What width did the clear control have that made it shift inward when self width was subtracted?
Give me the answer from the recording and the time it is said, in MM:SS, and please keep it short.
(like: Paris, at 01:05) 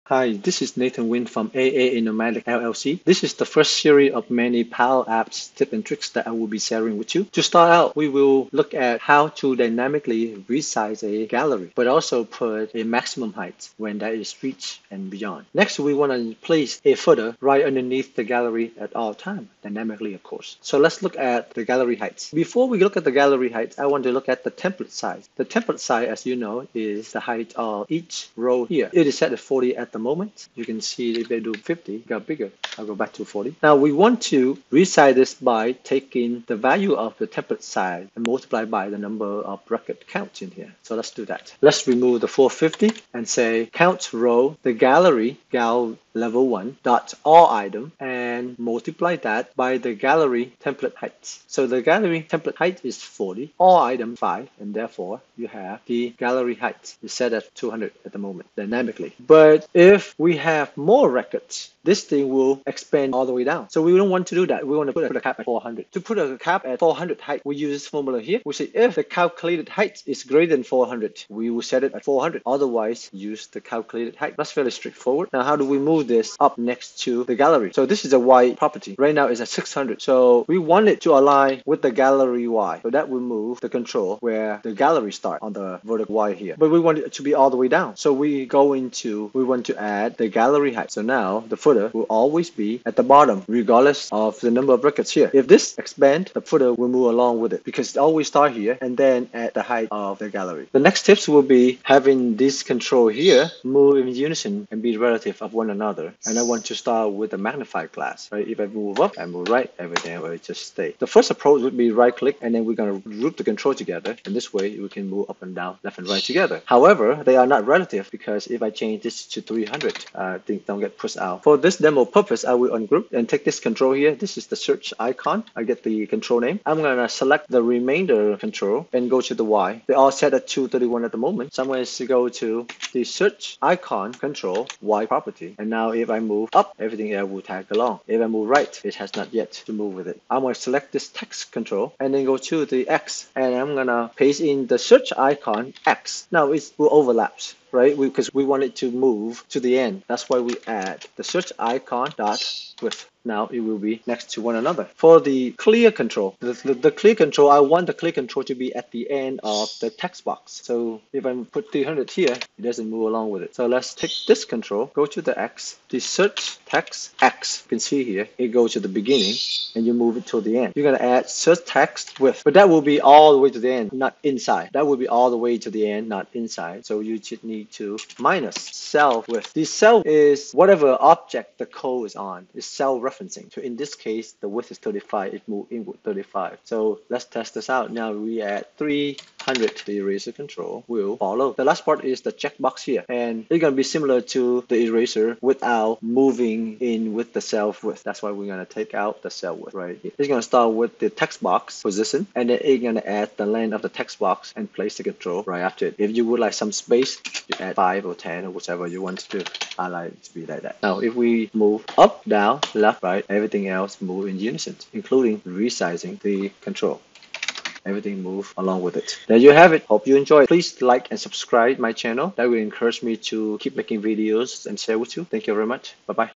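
35, at 03:04.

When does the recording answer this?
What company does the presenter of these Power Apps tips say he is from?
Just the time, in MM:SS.
00:01.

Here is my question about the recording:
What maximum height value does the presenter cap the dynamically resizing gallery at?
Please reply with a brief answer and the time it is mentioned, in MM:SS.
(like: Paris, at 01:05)
400, at 01:04.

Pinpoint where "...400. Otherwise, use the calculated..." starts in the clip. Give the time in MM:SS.
01:12.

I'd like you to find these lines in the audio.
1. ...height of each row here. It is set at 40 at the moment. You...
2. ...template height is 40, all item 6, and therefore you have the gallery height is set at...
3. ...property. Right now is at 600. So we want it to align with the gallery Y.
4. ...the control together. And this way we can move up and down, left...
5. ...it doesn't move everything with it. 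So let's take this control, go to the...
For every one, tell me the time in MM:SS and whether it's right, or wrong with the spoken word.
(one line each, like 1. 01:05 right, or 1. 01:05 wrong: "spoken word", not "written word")
1. 00:27 right
2. 00:52 wrong: "5", not "6"
3. 01:18 right
4. 01:53 right
5. 02:42 wrong: "along", not "everything".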